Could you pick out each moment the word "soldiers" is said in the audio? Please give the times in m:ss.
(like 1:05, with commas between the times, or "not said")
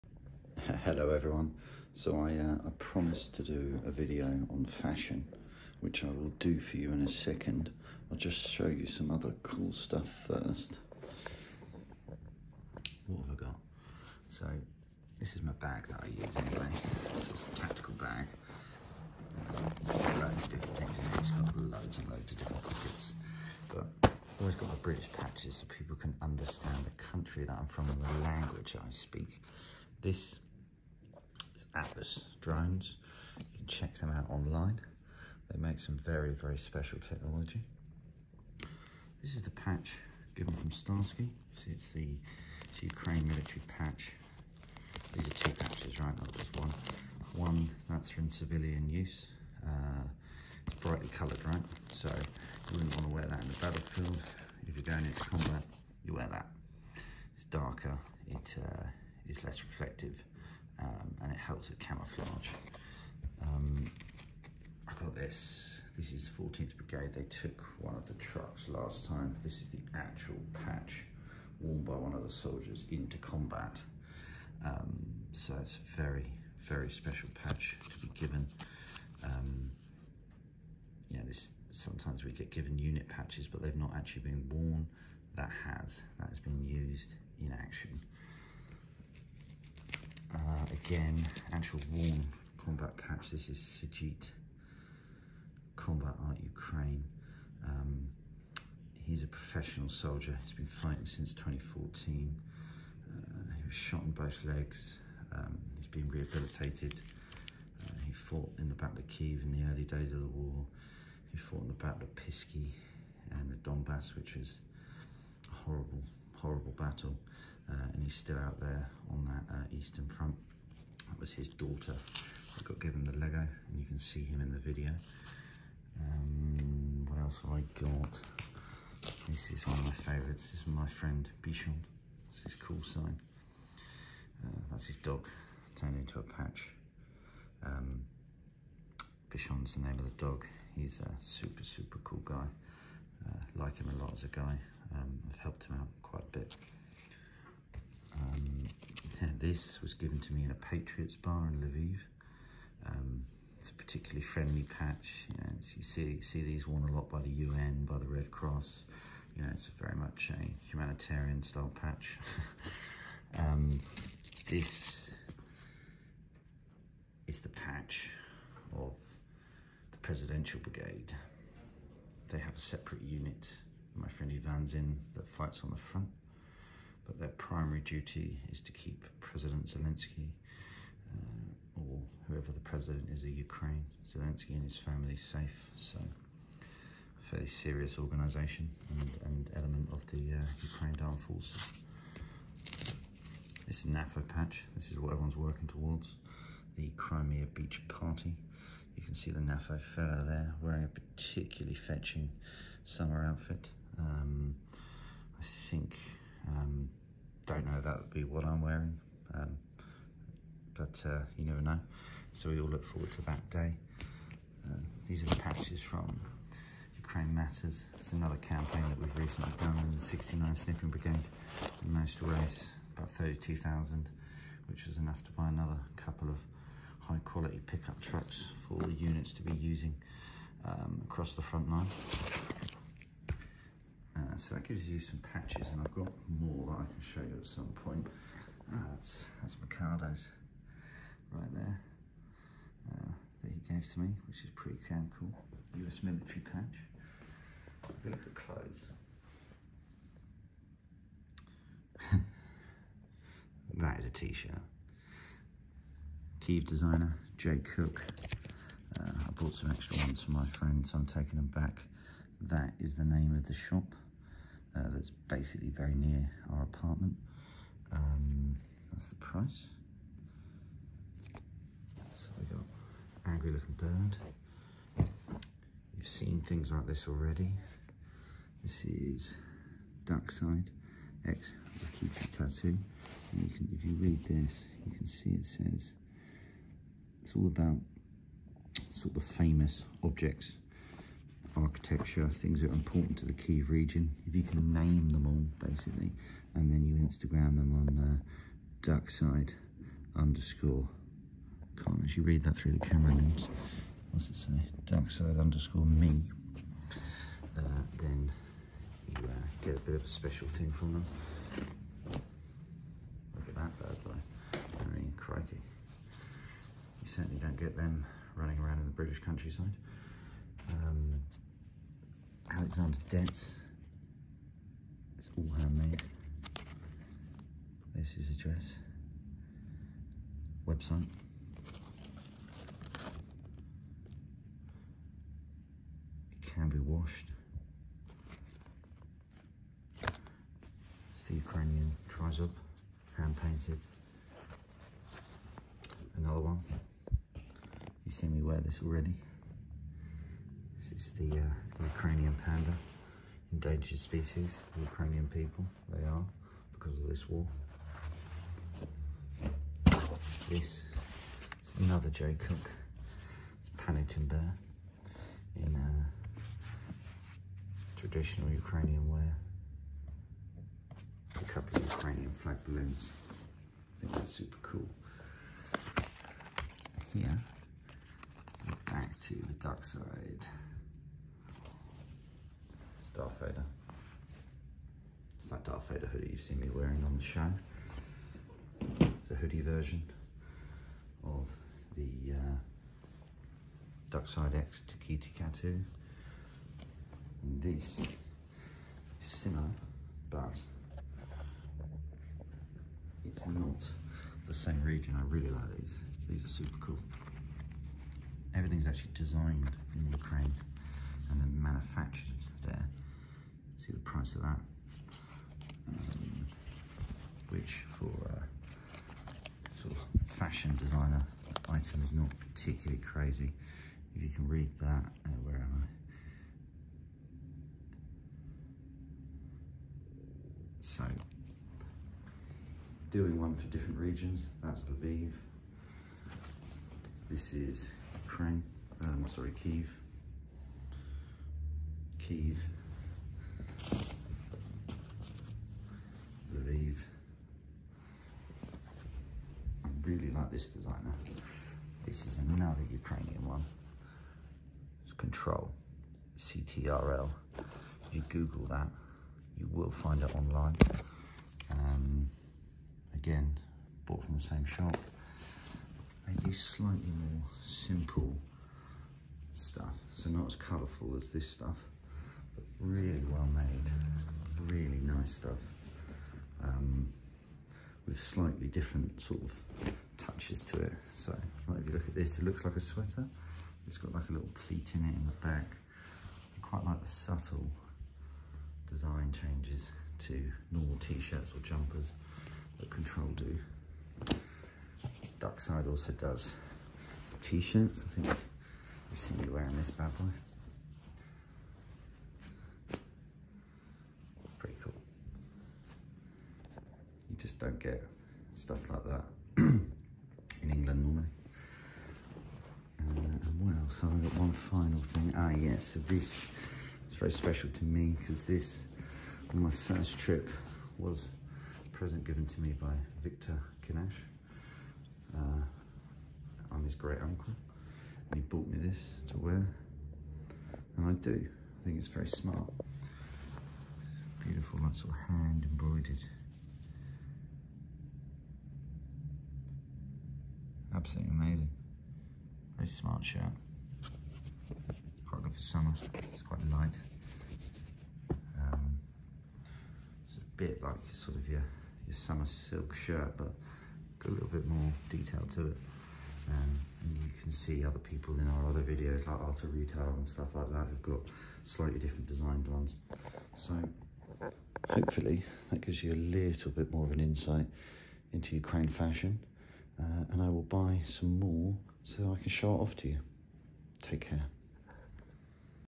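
1:12, 1:39.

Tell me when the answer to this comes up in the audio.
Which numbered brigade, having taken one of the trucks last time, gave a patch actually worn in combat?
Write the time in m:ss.
1:06.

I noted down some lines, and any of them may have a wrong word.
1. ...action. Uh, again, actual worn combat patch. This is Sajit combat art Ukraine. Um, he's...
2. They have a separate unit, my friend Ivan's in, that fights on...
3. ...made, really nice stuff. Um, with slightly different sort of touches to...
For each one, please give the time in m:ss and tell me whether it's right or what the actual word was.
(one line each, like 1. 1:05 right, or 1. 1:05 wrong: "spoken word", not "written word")
1. 1:27 right
2. 2:52 right
3. 7:53 right.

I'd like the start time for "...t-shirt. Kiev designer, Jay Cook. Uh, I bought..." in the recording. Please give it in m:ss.
4:14.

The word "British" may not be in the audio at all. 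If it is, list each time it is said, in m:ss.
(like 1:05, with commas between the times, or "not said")
0:24, 5:18.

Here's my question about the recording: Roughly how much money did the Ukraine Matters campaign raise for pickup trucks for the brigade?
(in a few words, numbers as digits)
32,000.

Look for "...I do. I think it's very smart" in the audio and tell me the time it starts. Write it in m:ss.
8:51.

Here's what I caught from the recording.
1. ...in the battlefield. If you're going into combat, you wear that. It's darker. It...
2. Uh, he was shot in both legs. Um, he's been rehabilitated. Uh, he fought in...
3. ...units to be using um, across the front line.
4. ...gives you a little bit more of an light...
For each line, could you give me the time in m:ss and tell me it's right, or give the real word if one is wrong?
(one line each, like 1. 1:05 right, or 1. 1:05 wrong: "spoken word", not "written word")
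1. 0:53 right
2. 1:43 right
3. 3:48 right
4. 9:25 wrong: "insight", not "light".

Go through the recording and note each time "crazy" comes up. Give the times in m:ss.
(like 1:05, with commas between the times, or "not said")
7:03.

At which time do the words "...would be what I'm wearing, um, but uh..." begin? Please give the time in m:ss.
3:27.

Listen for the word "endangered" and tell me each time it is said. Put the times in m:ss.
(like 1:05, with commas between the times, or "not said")
5:53.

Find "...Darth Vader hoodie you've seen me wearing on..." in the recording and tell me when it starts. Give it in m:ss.
6:25.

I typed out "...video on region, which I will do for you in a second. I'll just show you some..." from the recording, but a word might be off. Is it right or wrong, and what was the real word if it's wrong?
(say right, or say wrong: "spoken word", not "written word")
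wrong: "fashion", not "region".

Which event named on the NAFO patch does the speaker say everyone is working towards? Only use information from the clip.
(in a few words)
Crimea Beach Party.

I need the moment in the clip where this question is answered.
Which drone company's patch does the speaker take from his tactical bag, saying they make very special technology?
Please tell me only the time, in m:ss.
0:31.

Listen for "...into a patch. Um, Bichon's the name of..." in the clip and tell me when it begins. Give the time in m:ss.
2:15.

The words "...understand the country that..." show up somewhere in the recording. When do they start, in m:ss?
0:26.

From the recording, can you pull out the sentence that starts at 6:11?
A couple of Ukrainian flag balloons.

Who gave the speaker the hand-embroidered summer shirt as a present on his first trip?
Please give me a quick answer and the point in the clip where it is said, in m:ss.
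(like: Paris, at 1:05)
Victor Kinash, at 8:43.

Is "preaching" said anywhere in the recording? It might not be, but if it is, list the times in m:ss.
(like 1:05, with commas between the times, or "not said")
not said.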